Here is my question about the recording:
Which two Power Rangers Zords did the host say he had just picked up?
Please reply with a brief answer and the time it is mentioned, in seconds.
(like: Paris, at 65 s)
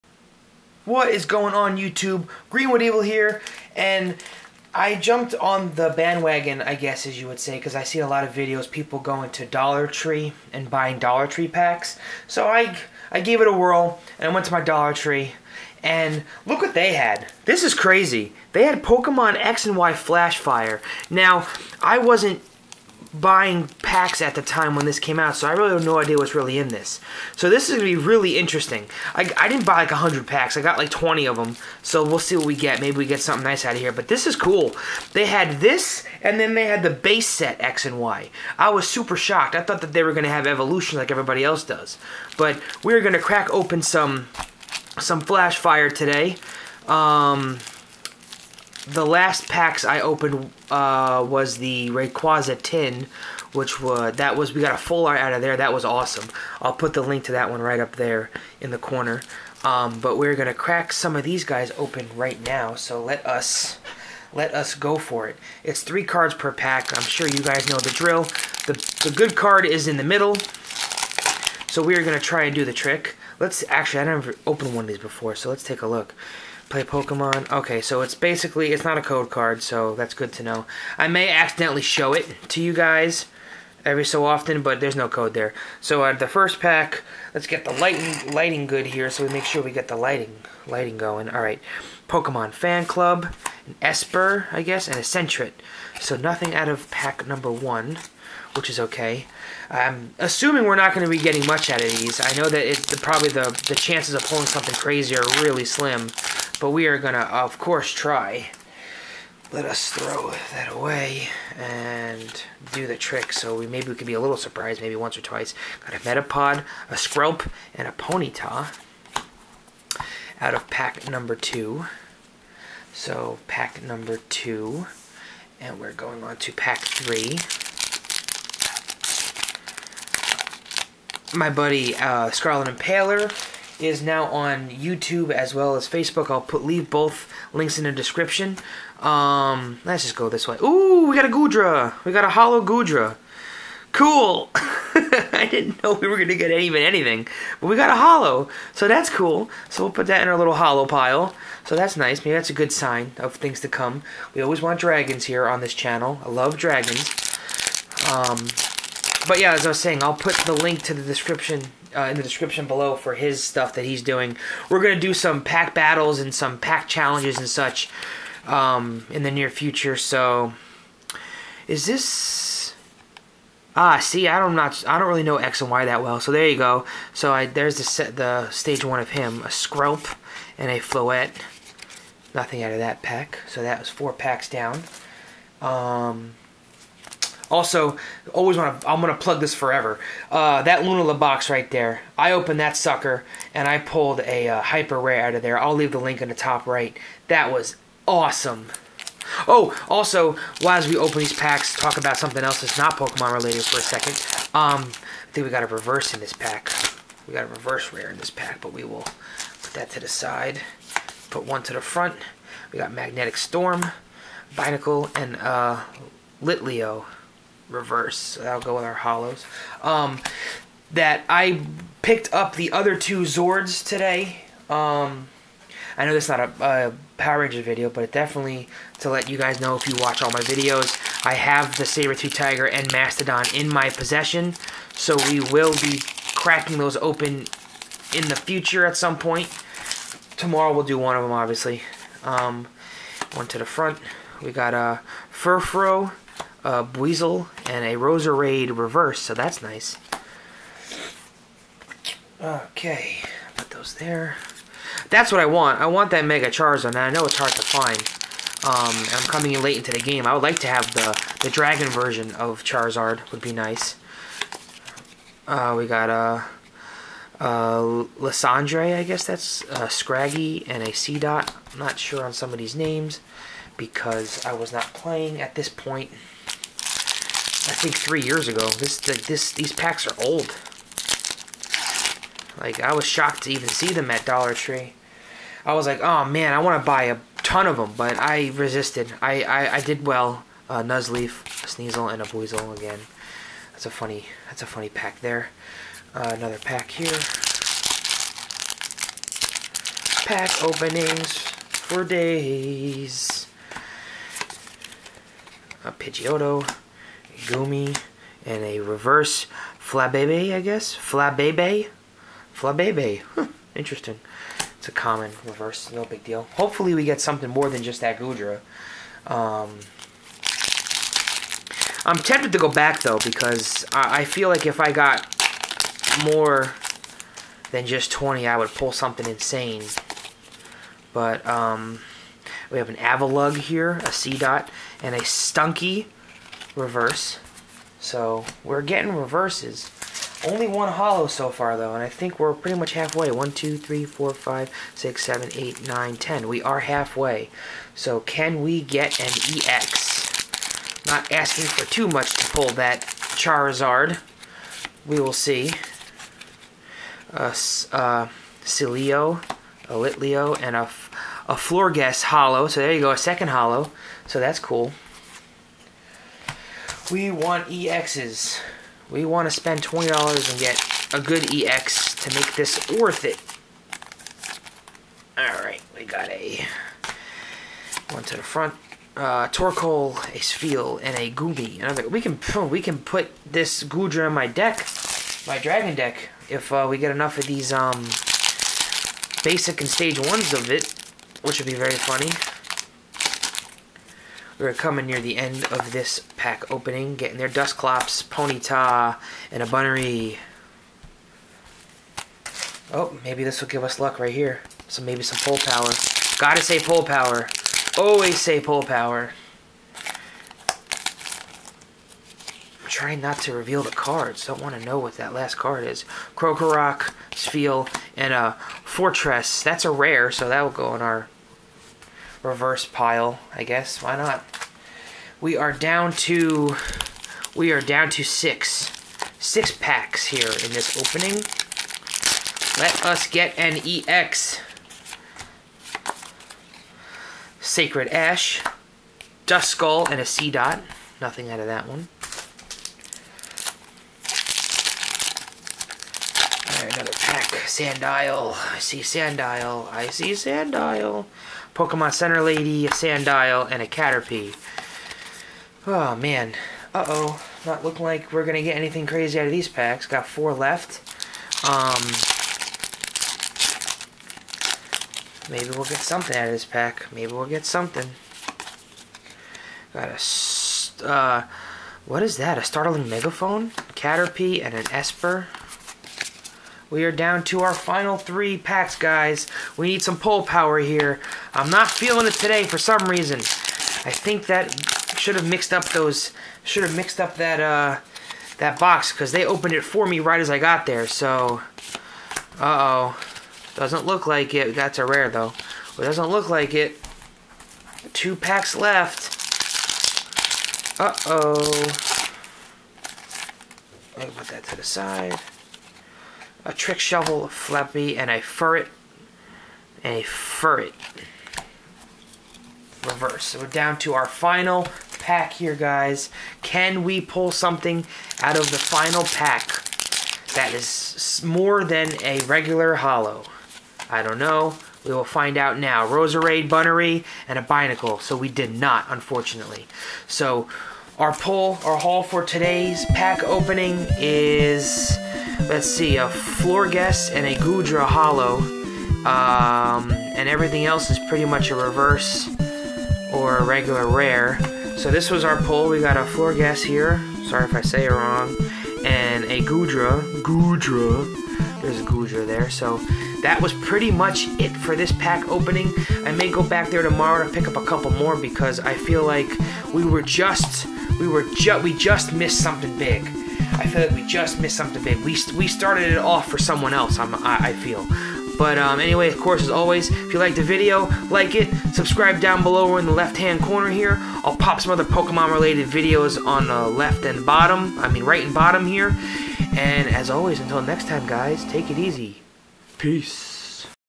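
Saber Tooth Tiger and Mastodon, at 231 s.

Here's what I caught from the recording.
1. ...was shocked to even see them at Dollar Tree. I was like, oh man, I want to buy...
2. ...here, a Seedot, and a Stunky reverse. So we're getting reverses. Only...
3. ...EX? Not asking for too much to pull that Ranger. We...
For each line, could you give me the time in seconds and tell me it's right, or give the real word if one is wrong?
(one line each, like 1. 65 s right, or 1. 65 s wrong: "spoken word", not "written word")
1. 282 s right
2. 333 s right
3. 349 s wrong: "Charizard", not "Ranger".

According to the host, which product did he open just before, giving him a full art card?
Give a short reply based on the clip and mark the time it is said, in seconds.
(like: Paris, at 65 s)
Rayquaza tin, at 51 s.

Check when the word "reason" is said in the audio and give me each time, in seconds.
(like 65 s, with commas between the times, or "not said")
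483 s.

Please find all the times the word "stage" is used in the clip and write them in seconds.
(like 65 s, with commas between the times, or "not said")
178 s, 389 s.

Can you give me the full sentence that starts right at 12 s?
So I, I gave it a whirl, and I went to my Dollar Tree, and look what they had.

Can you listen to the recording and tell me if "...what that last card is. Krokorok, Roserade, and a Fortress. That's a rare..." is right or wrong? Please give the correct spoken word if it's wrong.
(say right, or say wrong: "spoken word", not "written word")
wrong: "Spheal", not "Roserade".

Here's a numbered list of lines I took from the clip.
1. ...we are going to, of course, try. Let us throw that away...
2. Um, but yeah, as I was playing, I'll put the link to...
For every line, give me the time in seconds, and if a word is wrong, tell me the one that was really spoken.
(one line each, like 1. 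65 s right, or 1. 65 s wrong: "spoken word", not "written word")
1. 106 s right
2. 158 s wrong: "saying", not "playing".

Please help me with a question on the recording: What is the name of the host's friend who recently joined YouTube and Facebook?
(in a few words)
Scarlet Impaler.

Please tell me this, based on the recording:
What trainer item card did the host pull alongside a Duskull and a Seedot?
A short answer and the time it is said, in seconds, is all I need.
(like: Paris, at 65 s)
Sacred Ash, at 437 s.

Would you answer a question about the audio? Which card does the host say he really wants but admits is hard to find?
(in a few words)
Mega Charizard.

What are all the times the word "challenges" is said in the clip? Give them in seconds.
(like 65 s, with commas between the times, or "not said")
166 s.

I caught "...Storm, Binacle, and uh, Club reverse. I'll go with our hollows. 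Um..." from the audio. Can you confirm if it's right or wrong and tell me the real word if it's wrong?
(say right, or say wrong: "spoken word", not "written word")
wrong: "Litleo", not "Club".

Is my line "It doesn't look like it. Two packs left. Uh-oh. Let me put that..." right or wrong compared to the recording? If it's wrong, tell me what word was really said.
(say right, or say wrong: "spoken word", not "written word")
right.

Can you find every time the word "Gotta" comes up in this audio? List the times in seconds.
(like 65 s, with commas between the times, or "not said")
406 s.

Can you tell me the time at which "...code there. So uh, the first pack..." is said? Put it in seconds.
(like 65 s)
85 s.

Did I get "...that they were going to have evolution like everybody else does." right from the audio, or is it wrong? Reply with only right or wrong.
right.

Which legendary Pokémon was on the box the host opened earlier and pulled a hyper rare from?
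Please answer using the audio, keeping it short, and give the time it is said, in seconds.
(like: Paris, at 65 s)
Lunala, at 190 s.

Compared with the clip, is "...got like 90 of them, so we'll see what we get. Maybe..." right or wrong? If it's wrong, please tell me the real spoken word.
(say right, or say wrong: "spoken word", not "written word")
wrong: "20", not "90".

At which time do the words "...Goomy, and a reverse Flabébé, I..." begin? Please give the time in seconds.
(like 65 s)
307 s.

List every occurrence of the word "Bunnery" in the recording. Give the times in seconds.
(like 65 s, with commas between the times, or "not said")
399 s, 526 s.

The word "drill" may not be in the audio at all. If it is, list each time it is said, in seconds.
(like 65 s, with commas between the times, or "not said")
67 s.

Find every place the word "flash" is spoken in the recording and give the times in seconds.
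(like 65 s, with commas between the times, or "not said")
19 s, 45 s.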